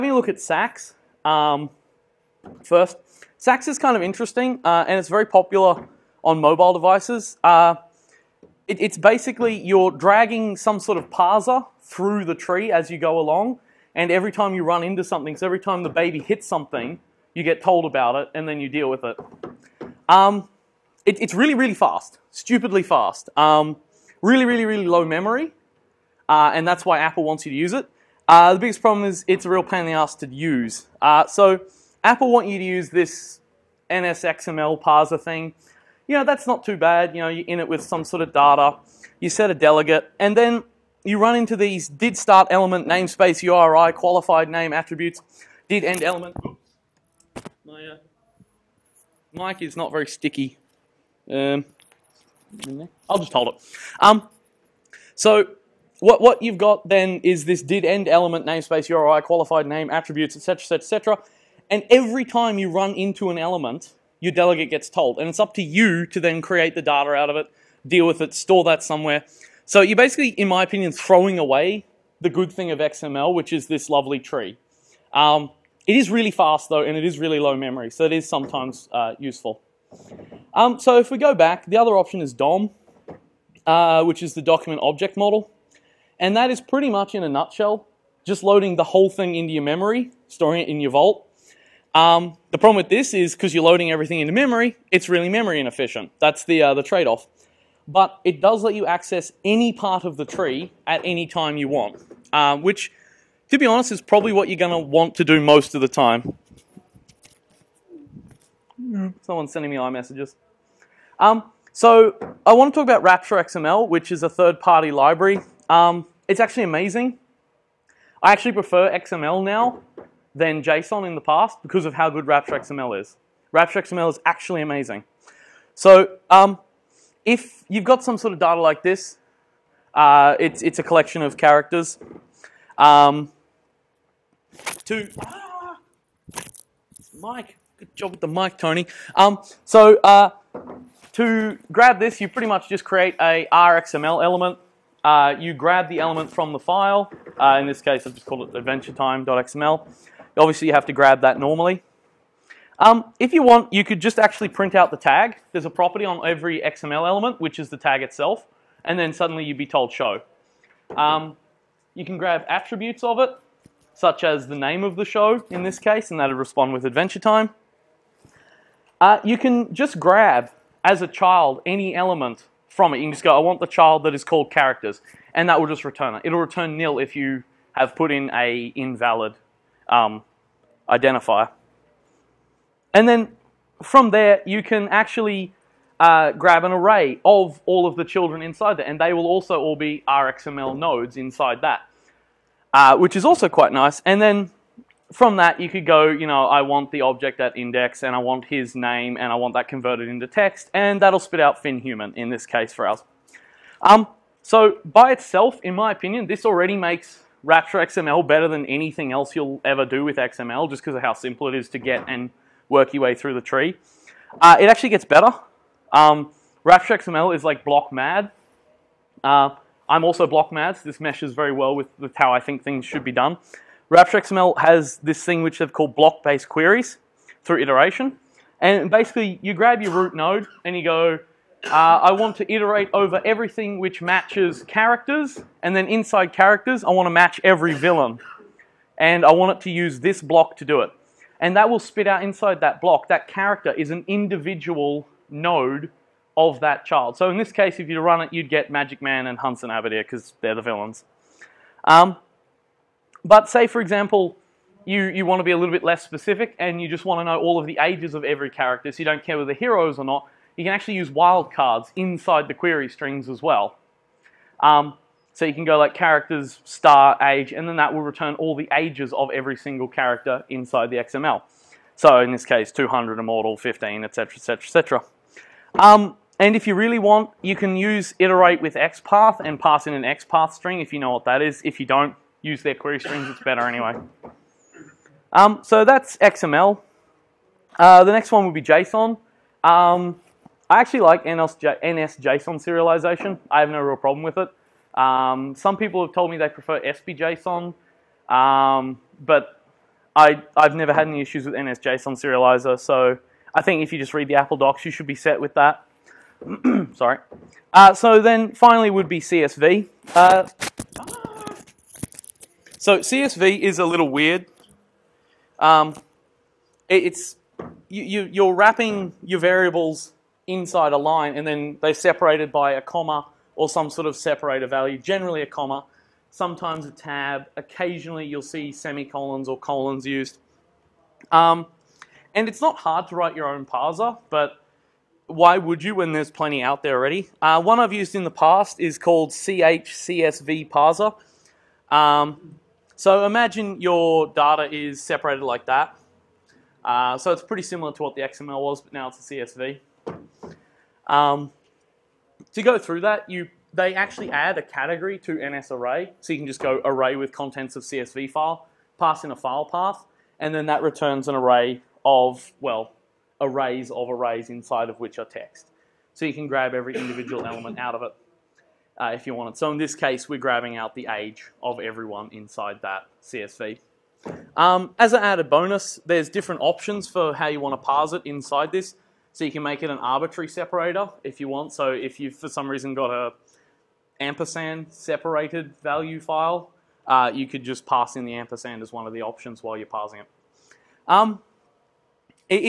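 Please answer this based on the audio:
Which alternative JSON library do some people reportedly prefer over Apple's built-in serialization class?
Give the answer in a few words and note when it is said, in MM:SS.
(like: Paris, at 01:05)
SBJSON, at 04:56.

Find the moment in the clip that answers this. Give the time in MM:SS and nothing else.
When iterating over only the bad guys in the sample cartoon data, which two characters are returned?
04:08.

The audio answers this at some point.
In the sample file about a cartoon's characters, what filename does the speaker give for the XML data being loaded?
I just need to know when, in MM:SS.
02:28.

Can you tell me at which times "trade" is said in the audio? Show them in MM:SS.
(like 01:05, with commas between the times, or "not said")
01:36.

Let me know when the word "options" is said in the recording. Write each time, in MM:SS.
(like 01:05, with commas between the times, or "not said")
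01:21, 06:16, 06:29.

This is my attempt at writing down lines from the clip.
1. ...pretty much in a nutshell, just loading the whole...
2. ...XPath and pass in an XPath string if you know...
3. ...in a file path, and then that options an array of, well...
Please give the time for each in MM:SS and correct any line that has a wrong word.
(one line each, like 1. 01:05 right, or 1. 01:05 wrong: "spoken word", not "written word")
1. 01:26 right
2. 04:38 right
3. 05:59 wrong: "returns", not "options".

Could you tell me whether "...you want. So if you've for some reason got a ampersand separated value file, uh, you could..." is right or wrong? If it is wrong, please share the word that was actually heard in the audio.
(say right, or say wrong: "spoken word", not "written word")
right.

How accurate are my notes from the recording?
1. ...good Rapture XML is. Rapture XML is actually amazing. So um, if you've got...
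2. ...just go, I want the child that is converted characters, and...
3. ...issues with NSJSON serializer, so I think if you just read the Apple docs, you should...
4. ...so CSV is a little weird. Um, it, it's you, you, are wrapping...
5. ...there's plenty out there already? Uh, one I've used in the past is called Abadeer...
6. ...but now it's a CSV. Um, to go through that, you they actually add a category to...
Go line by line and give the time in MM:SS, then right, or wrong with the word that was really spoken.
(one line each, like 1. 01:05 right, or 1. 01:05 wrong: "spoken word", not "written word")
1. 02:02 right
2. 02:53 wrong: "called", not "converted"
3. 05:01 right
4. 05:12 right
5. 05:36 wrong: "CHCSV", not "Abadeer"
6. 05:48 right.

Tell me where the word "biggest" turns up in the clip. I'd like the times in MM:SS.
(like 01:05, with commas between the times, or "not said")
00:28.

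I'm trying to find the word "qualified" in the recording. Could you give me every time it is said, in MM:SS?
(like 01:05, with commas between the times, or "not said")
00:43, 00:59.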